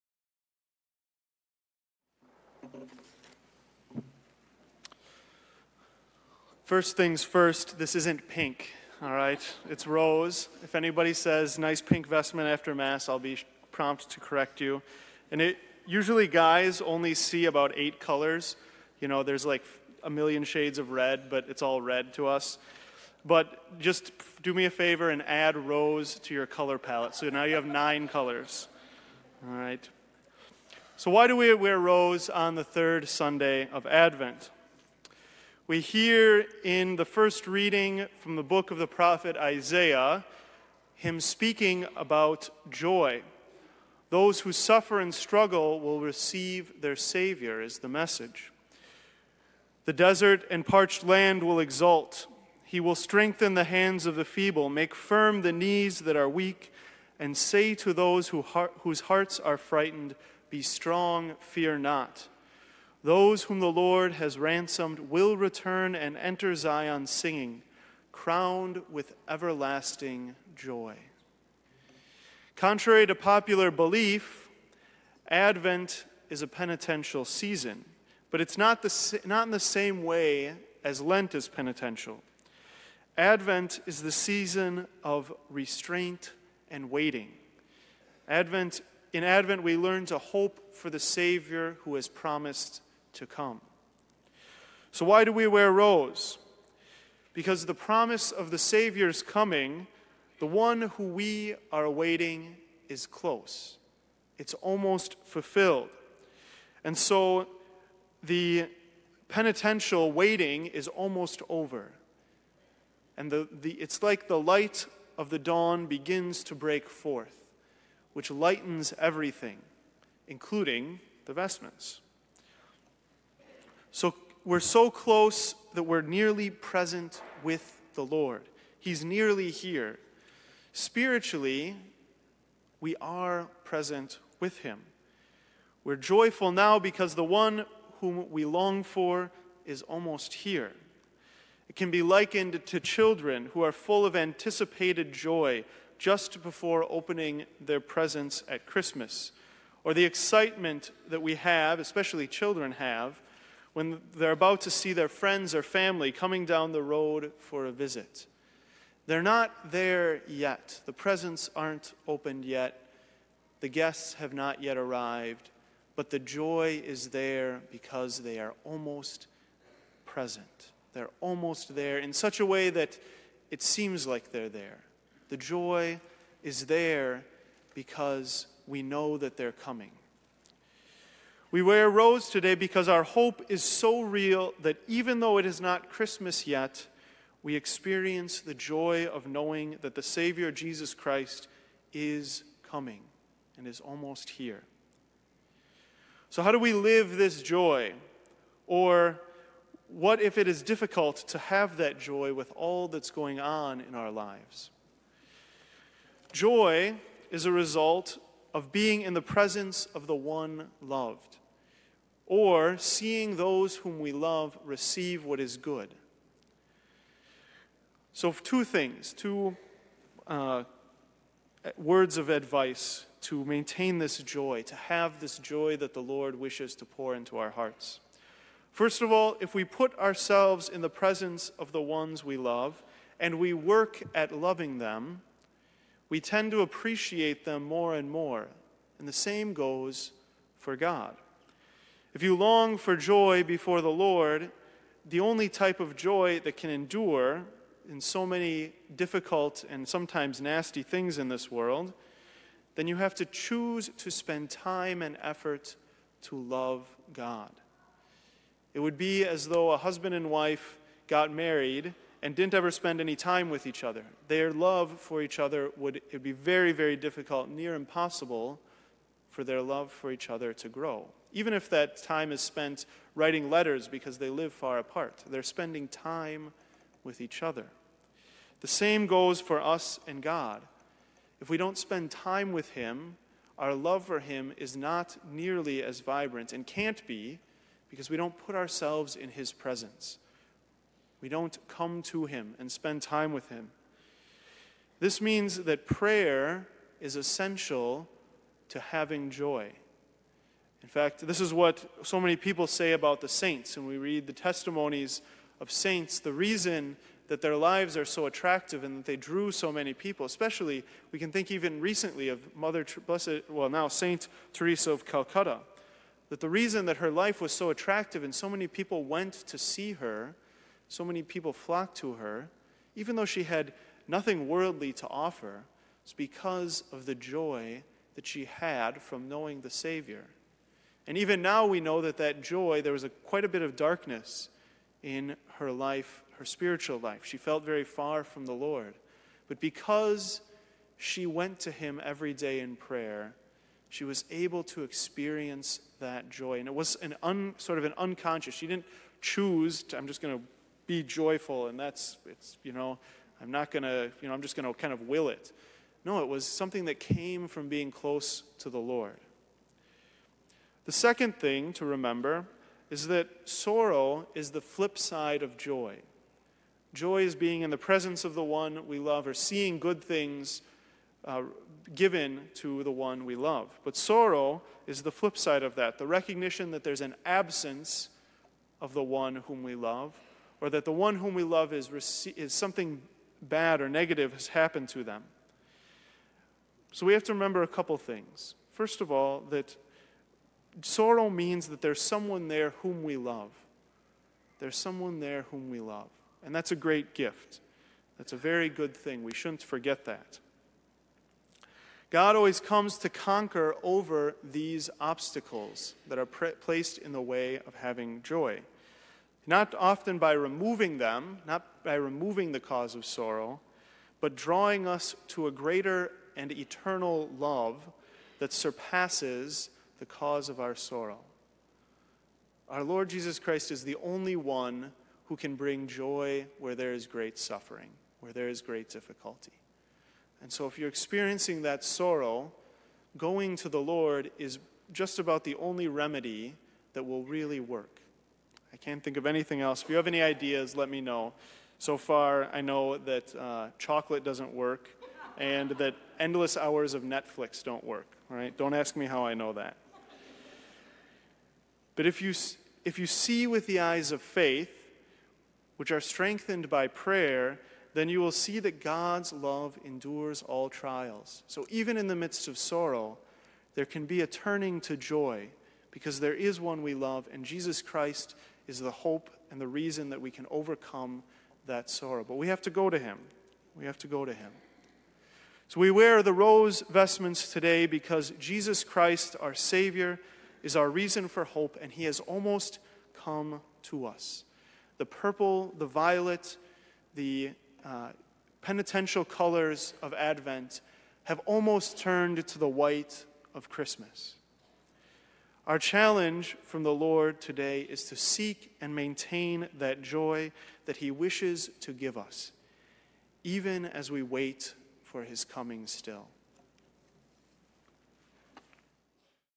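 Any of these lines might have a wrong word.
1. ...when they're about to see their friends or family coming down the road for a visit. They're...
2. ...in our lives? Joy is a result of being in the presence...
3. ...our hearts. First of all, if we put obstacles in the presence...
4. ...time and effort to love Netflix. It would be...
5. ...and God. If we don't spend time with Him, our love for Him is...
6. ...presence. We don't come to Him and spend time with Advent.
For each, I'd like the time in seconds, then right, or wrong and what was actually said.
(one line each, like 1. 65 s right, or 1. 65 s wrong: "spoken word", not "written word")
1. 153 s right
2. 203 s right
3. 227 s wrong: "ourselves", not "obstacles"
4. 254 s wrong: "God", not "Netflix"
5. 280 s right
6. 289 s wrong: "Him", not "Advent".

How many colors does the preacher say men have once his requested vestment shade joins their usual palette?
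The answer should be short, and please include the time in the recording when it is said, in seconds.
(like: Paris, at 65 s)
9, at 27 s.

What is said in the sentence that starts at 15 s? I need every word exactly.
And it usually guys only see about eight colors.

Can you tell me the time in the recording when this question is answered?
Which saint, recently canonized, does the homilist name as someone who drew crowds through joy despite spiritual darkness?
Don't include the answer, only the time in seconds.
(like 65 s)
314 s.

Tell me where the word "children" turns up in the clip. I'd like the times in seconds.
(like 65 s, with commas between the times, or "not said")
142 s, 152 s.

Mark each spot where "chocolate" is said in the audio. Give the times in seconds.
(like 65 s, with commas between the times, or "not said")
443 s.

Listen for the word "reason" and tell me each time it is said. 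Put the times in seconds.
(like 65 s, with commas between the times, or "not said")
306 s, 316 s, 469 s, 480 s.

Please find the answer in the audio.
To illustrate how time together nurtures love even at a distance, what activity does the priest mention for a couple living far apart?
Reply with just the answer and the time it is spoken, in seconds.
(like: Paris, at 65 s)
Writing letters, at 273 s.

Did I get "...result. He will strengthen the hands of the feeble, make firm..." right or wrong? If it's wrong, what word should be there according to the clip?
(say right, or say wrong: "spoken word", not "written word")
wrong: "exult", not "result".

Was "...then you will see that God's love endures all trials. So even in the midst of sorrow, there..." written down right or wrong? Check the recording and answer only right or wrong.
right.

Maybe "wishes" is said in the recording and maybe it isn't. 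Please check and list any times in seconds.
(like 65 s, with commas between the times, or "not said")
226 s, 501 s.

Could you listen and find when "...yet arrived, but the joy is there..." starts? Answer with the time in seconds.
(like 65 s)
164 s.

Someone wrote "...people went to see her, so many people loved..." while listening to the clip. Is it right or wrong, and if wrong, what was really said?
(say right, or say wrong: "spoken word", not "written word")
wrong: "flocked", not "loved".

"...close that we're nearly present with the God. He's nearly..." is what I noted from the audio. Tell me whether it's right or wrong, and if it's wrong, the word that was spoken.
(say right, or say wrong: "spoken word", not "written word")
wrong: "Lord", not "God".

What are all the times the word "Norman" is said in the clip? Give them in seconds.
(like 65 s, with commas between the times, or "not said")
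not said.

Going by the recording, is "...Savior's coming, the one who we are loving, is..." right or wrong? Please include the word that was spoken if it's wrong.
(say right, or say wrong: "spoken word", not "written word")
wrong: "awaiting", not "loving".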